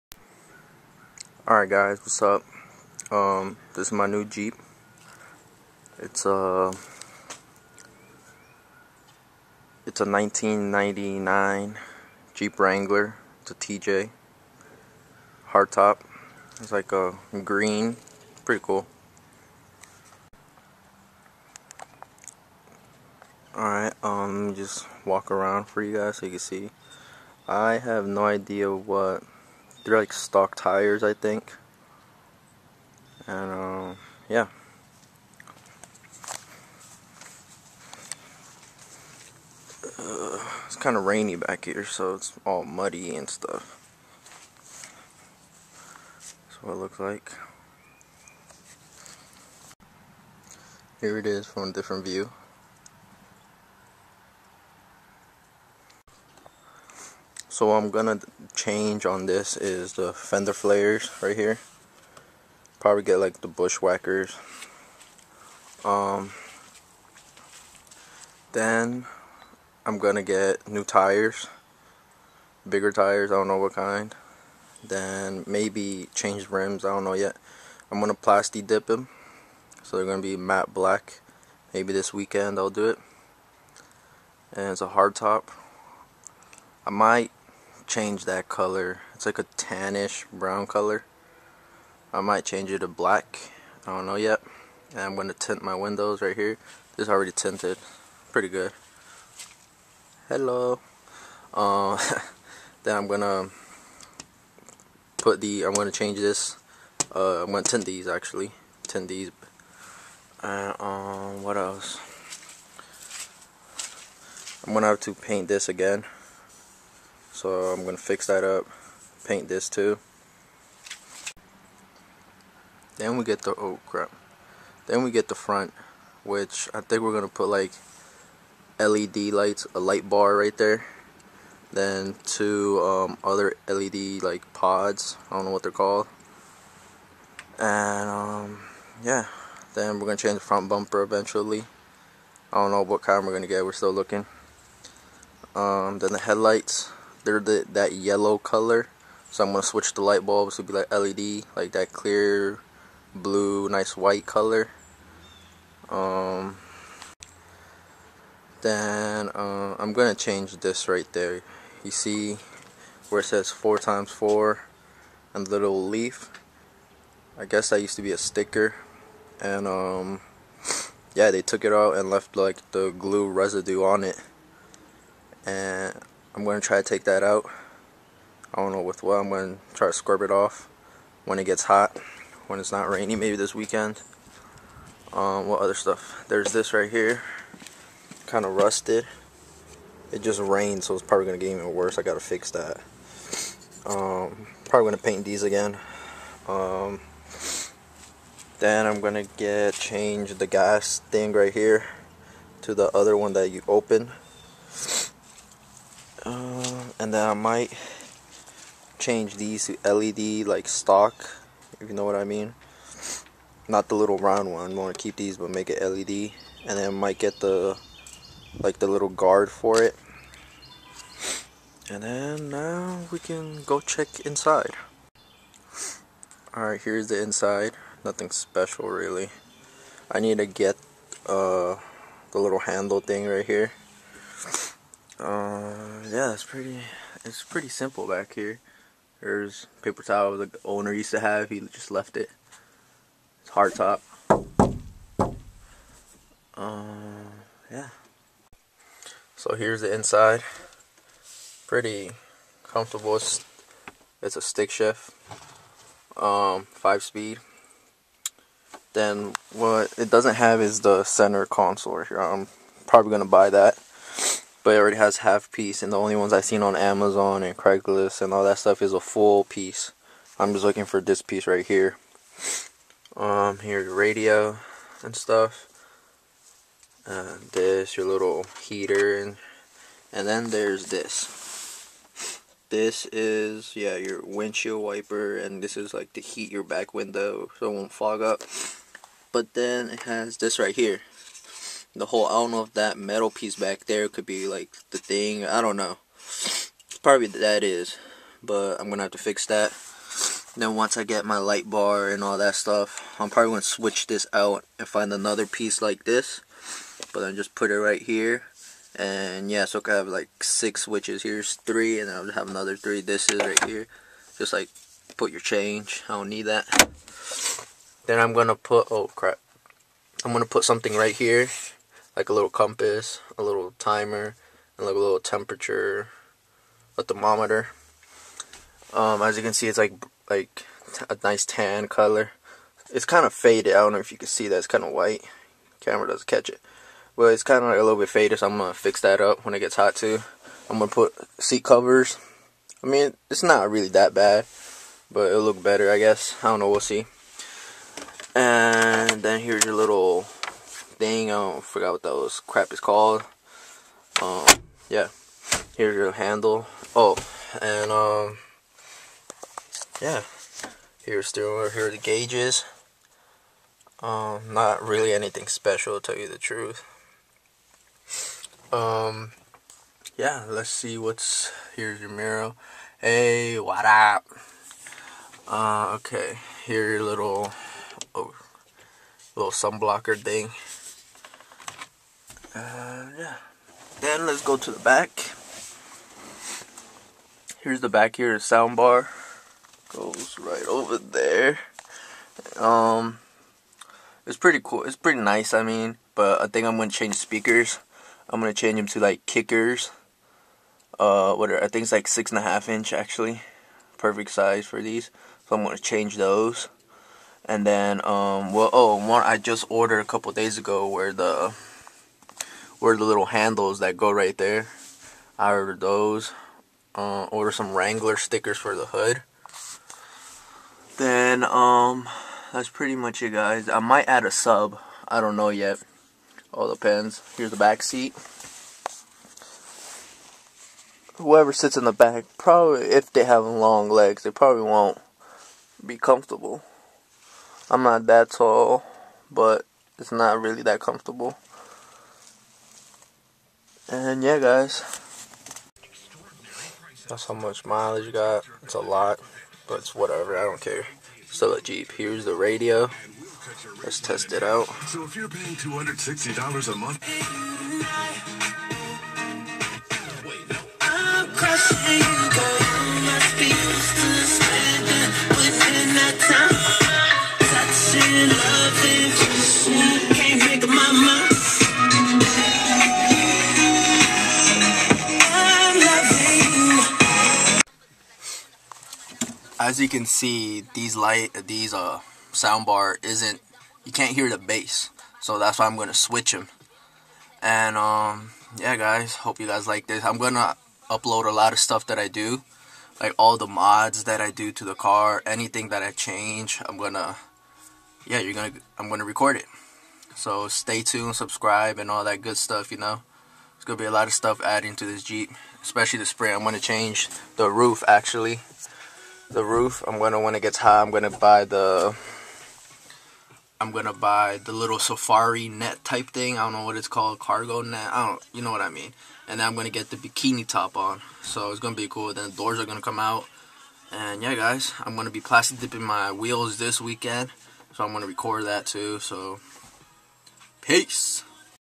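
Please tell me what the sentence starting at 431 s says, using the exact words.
Whoever sits in the back, probably, if they have long legs, they probably won't be comfortable.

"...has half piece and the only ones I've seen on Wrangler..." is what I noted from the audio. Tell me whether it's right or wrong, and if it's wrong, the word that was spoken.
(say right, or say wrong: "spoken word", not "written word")
wrong: "Amazon", not "Wrangler".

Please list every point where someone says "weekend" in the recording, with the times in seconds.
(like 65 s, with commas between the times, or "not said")
82 s, 183 s, 526 s.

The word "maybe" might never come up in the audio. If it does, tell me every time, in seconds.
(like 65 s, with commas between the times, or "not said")
75 s, 81 s, 183 s.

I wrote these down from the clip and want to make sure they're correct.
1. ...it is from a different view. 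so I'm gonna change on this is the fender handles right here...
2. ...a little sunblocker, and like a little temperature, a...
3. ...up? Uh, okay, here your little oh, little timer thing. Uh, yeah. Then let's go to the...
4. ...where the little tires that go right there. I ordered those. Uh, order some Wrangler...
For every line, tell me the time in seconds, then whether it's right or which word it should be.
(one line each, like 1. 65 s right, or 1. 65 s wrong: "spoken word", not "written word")
1. 51 s wrong: "flares", not "handles"
2. 323 s wrong: "timer", not "sunblocker"
3. 373 s wrong: "sunblocker", not "timer"
4. 412 s wrong: "handles", not "tires".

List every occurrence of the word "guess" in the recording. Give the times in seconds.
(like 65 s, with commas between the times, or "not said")
167 s, 345 s.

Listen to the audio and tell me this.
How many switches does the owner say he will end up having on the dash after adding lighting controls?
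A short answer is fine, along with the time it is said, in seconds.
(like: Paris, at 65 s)
6, at 310 s.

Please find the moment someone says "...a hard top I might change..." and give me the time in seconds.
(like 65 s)
84 s.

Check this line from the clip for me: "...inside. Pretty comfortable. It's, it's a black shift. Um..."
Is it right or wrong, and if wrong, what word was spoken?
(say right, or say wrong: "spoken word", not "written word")
wrong: "stick", not "black".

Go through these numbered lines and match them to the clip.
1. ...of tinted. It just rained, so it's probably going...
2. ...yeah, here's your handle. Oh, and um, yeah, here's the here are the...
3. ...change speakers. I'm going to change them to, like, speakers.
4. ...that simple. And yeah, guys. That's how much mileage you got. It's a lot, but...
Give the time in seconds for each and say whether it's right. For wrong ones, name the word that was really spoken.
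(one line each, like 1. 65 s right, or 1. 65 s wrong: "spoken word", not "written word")
1. 188 s wrong: "rusted", not "tinted"
2. 354 s right
3. 396 s wrong: "kickers", not "speakers"
4. 440 s wrong: "comfortable", not "simple".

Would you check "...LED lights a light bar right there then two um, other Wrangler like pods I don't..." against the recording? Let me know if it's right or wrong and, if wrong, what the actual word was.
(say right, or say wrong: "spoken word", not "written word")
wrong: "LED", not "Wrangler".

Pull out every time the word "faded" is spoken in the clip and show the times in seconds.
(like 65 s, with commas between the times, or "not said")
333 s, 338 s.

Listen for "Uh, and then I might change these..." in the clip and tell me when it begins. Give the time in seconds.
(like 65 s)
206 s.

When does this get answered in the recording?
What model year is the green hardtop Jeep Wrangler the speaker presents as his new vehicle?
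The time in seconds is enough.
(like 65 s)
10 s.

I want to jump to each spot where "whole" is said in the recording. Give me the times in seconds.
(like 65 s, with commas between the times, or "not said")
292 s.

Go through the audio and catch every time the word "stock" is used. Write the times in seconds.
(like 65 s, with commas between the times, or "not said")
30 s, 210 s.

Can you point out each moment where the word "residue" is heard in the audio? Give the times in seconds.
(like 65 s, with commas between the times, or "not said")
173 s.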